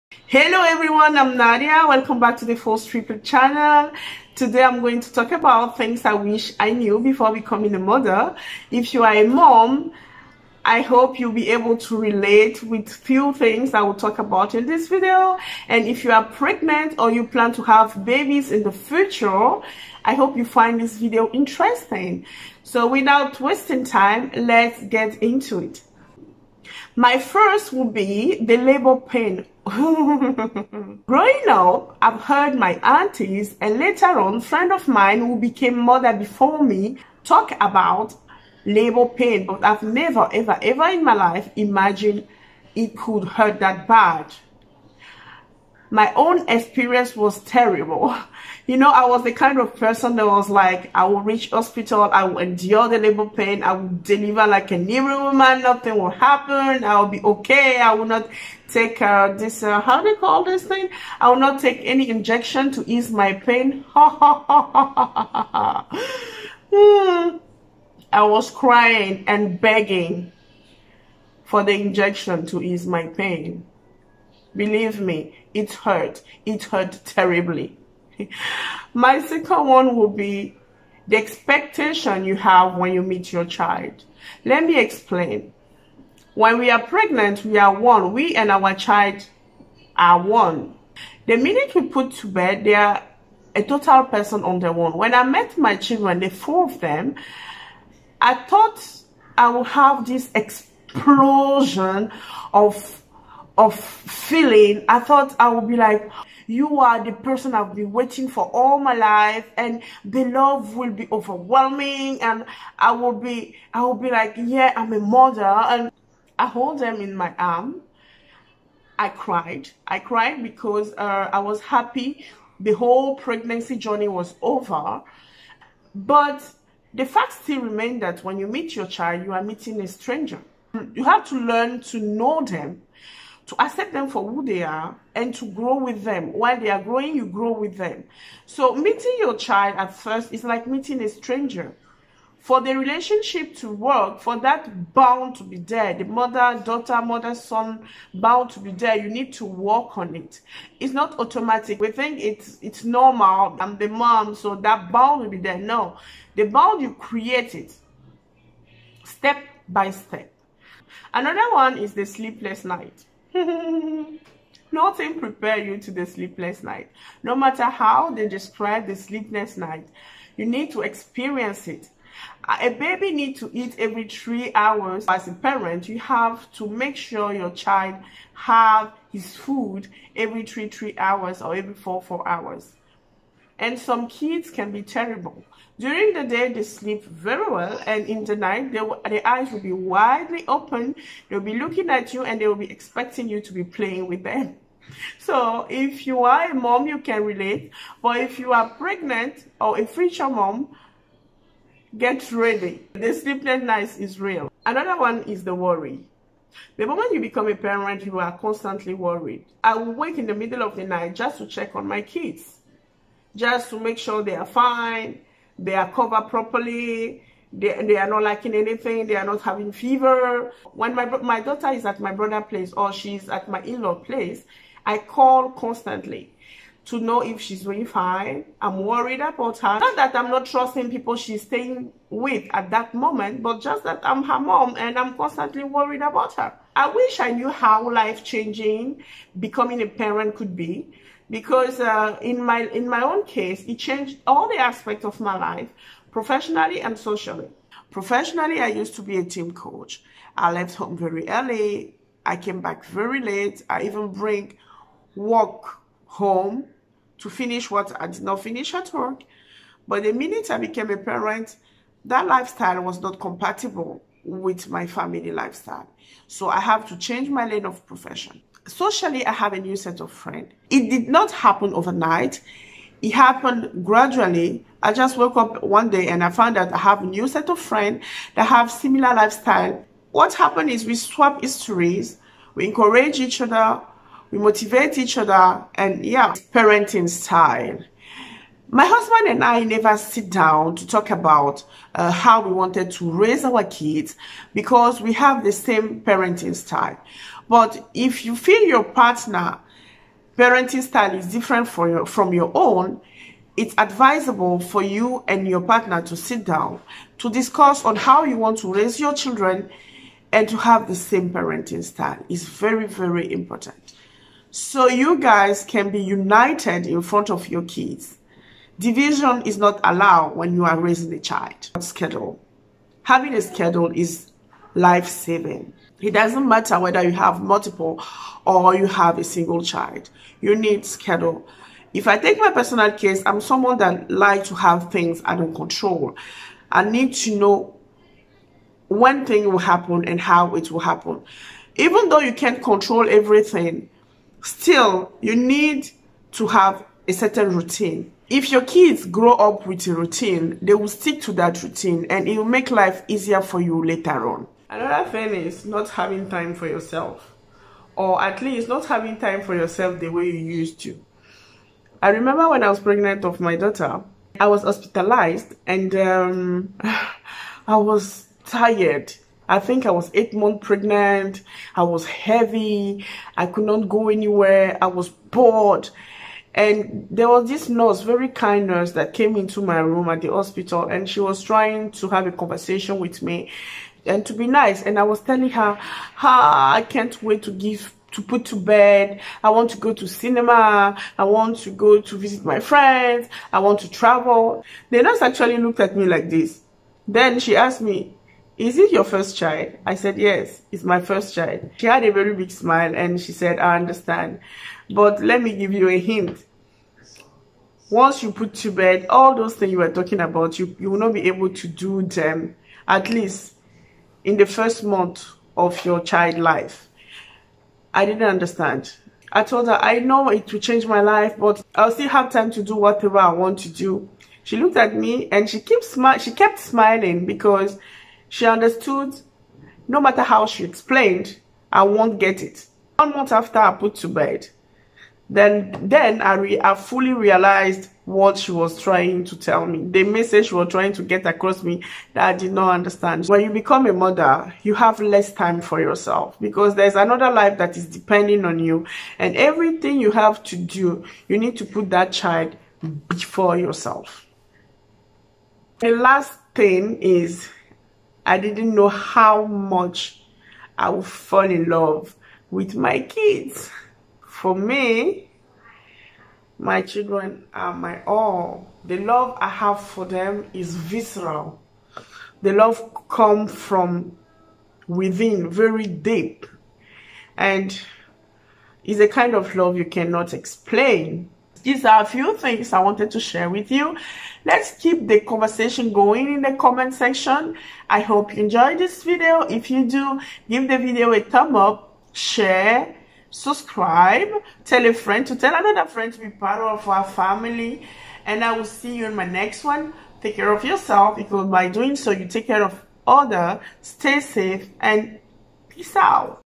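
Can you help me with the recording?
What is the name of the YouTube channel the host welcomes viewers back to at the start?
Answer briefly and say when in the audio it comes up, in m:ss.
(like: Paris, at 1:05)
Fols Triple, at 0:02.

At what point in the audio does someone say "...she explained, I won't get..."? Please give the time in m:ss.
7:10.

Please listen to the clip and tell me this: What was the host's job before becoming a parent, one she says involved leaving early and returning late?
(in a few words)
team coach.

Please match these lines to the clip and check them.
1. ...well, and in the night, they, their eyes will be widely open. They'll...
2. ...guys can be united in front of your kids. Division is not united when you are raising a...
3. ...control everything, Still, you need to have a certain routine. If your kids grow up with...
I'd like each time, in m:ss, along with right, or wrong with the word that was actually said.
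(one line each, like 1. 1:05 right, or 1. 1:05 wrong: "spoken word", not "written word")
1. 3:07 right
2. 5:15 wrong: "allowed", not "united"
3. 5:42 right.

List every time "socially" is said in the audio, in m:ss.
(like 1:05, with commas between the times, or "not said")
4:06, 4:28.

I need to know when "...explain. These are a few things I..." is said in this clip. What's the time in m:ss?
8:00.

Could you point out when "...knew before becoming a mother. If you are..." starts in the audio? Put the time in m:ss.
0:06.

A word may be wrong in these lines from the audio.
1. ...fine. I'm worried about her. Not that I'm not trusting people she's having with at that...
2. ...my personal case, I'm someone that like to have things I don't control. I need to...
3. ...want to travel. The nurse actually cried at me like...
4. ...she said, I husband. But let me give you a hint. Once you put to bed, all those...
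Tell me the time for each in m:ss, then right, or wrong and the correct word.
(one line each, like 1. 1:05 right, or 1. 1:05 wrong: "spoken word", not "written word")
1. 3:47 wrong: "staying", not "having"
2. 5:32 right
3. 6:33 wrong: "looked", not "cried"
4. 6:43 wrong: "understand", not "husband".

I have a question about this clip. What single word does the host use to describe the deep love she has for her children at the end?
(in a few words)
visceral.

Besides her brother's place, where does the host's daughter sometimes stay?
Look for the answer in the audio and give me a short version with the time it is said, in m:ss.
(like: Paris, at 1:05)
in-law place, at 3:43.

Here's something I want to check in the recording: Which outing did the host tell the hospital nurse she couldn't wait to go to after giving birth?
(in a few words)
cinema.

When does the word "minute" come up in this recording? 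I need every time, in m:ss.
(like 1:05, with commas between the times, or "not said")
1:31, 4:20.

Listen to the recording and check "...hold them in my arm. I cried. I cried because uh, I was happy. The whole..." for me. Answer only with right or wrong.
right.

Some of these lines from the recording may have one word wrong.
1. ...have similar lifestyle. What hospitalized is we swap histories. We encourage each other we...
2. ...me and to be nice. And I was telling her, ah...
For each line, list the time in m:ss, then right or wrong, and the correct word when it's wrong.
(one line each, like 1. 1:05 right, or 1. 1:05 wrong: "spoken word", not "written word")
1. 4:38 wrong: "happened", not "hospitalized"
2. 6:23 right.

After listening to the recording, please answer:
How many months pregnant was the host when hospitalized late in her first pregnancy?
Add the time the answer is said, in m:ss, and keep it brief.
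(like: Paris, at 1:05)
8, at 6:10.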